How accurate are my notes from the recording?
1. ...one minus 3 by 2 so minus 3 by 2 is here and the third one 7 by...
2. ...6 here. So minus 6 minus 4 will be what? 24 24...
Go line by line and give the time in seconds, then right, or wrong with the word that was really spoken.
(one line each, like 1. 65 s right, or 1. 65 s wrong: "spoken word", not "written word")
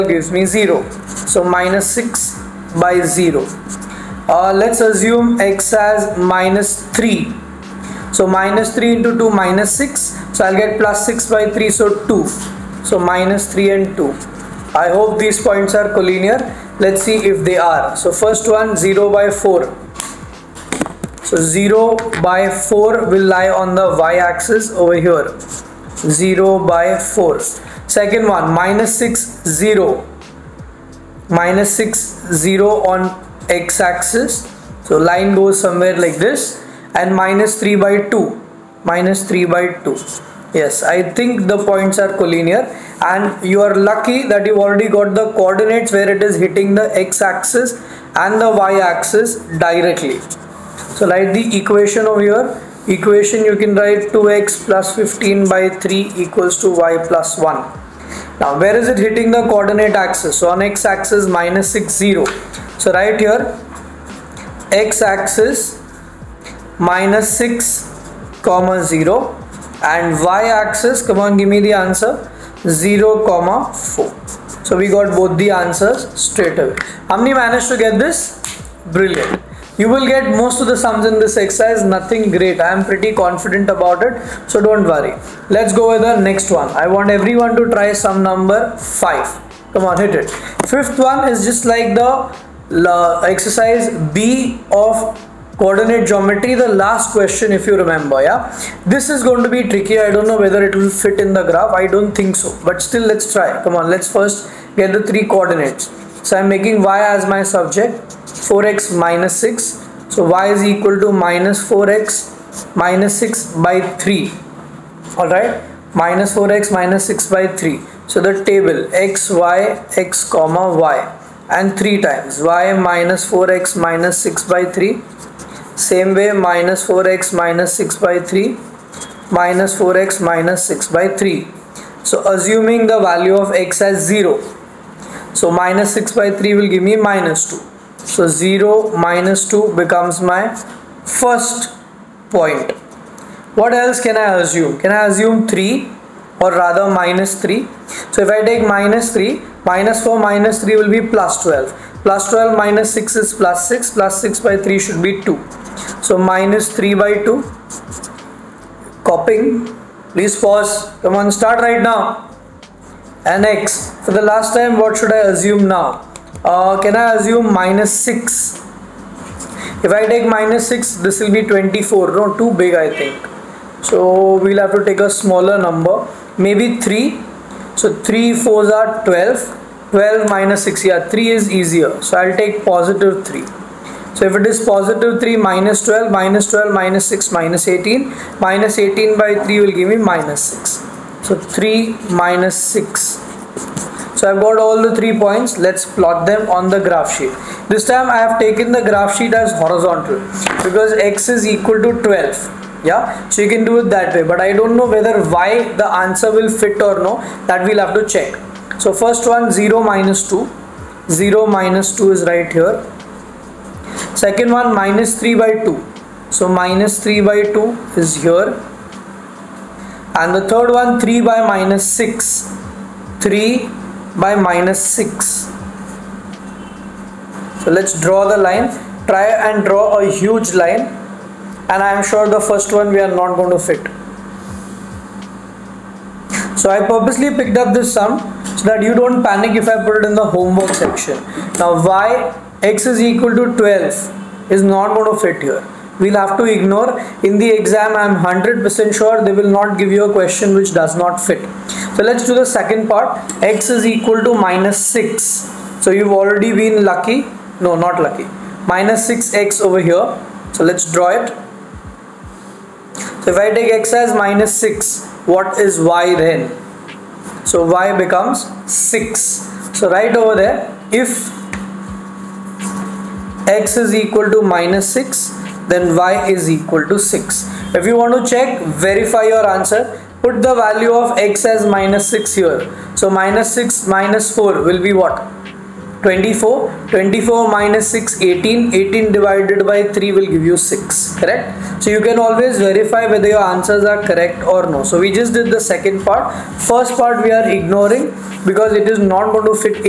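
1. 214 s wrong: "3", not "7"
2. 282 s right.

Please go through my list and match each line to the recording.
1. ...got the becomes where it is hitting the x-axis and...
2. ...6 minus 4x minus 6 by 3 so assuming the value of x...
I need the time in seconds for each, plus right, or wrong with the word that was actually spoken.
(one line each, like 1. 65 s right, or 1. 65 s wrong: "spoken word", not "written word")
1. 44 s wrong: "coordinates", not "becomes"
2. 128 s wrong: "3", not "6".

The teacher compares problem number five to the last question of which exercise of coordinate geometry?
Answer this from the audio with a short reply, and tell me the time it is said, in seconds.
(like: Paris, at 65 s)
Exercise B, at 93 s.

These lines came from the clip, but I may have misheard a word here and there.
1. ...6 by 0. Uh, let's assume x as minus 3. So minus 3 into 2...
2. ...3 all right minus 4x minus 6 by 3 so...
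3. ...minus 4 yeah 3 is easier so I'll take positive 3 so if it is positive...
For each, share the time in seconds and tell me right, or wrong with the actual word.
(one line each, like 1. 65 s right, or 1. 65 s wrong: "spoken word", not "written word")
1. 1 s right
2. 113 s right
3. 180 s wrong: "6", not "4".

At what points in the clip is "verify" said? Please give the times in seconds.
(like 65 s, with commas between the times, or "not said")
278 s, 292 s.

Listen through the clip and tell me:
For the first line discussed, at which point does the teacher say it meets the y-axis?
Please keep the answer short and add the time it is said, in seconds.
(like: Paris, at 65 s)
(0, 4), at 72 s.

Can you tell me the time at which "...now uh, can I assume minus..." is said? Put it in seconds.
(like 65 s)
165 s.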